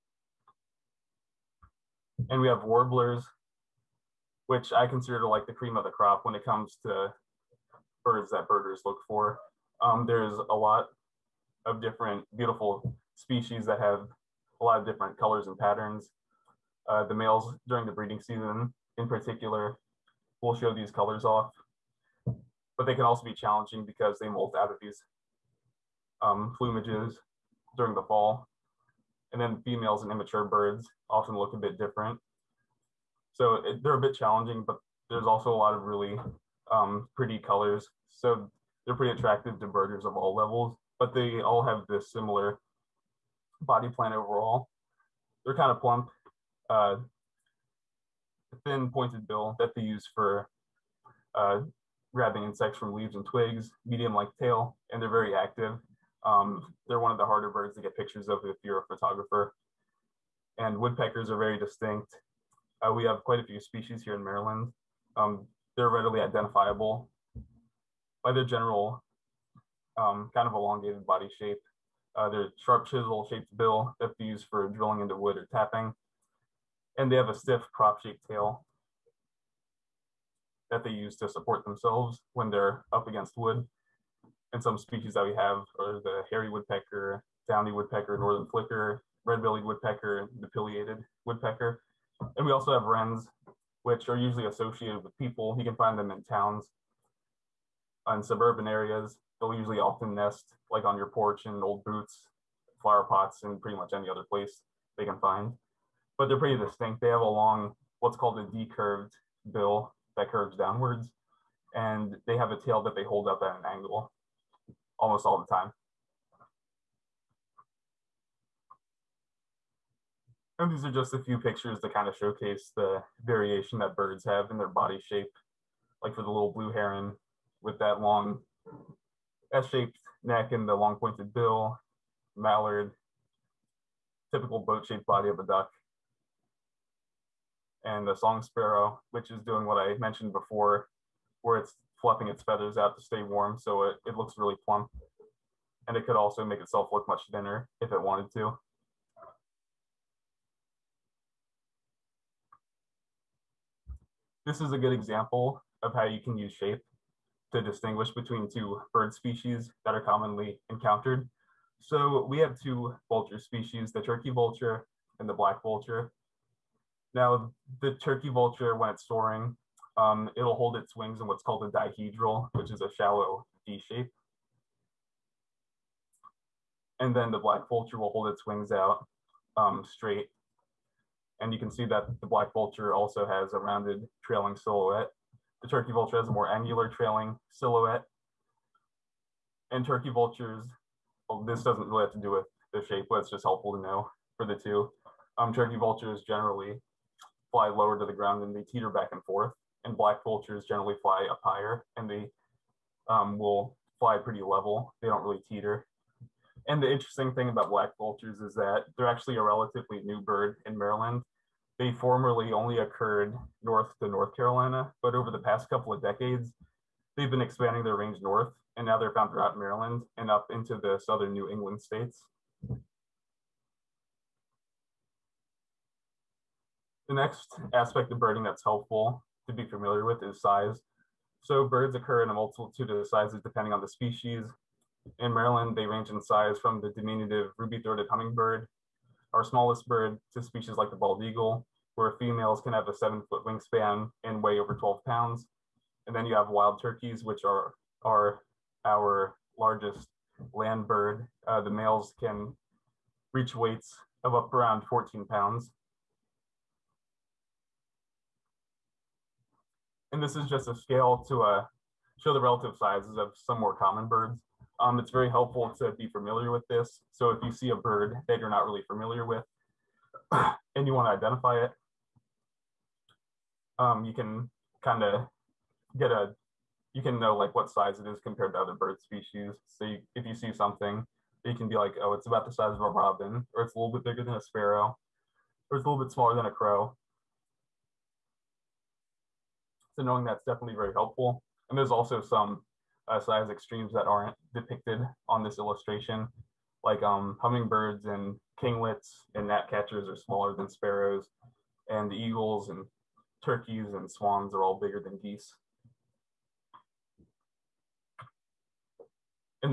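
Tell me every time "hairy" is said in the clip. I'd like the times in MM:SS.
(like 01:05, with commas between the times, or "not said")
01:26.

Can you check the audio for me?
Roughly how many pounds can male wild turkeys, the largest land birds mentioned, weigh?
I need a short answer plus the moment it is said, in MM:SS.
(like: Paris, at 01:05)
14 pounds, at 04:14.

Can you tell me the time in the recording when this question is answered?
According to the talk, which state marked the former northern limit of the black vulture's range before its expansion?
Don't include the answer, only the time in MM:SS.
03:34.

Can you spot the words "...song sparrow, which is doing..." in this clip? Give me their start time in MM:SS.
02:18.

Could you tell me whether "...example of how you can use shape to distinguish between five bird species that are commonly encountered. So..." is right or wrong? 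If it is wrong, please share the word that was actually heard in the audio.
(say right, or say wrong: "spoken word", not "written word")
wrong: "two", not "five".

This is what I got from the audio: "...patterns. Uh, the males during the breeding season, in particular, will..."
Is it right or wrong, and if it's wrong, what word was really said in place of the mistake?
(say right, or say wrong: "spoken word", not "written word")
right.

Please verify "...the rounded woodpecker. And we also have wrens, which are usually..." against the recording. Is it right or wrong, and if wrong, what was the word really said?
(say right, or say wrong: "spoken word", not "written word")
wrong: "pileated", not "rounded".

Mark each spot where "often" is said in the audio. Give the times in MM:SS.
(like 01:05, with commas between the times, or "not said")
00:31, 01:39.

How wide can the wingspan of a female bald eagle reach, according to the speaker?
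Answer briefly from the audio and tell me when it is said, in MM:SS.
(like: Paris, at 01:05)
7 feet, at 04:02.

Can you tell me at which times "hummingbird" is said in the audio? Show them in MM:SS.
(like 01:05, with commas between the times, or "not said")
03:58, 04:57.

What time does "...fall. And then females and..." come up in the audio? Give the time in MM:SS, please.
00:28.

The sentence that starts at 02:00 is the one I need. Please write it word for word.
And these are just a few pictures to kind of showcase the variation that birds have in their body shape.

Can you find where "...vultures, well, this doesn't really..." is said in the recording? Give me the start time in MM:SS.
03:10.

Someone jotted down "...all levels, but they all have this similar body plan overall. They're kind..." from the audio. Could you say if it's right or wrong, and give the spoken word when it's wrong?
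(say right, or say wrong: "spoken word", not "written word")
right.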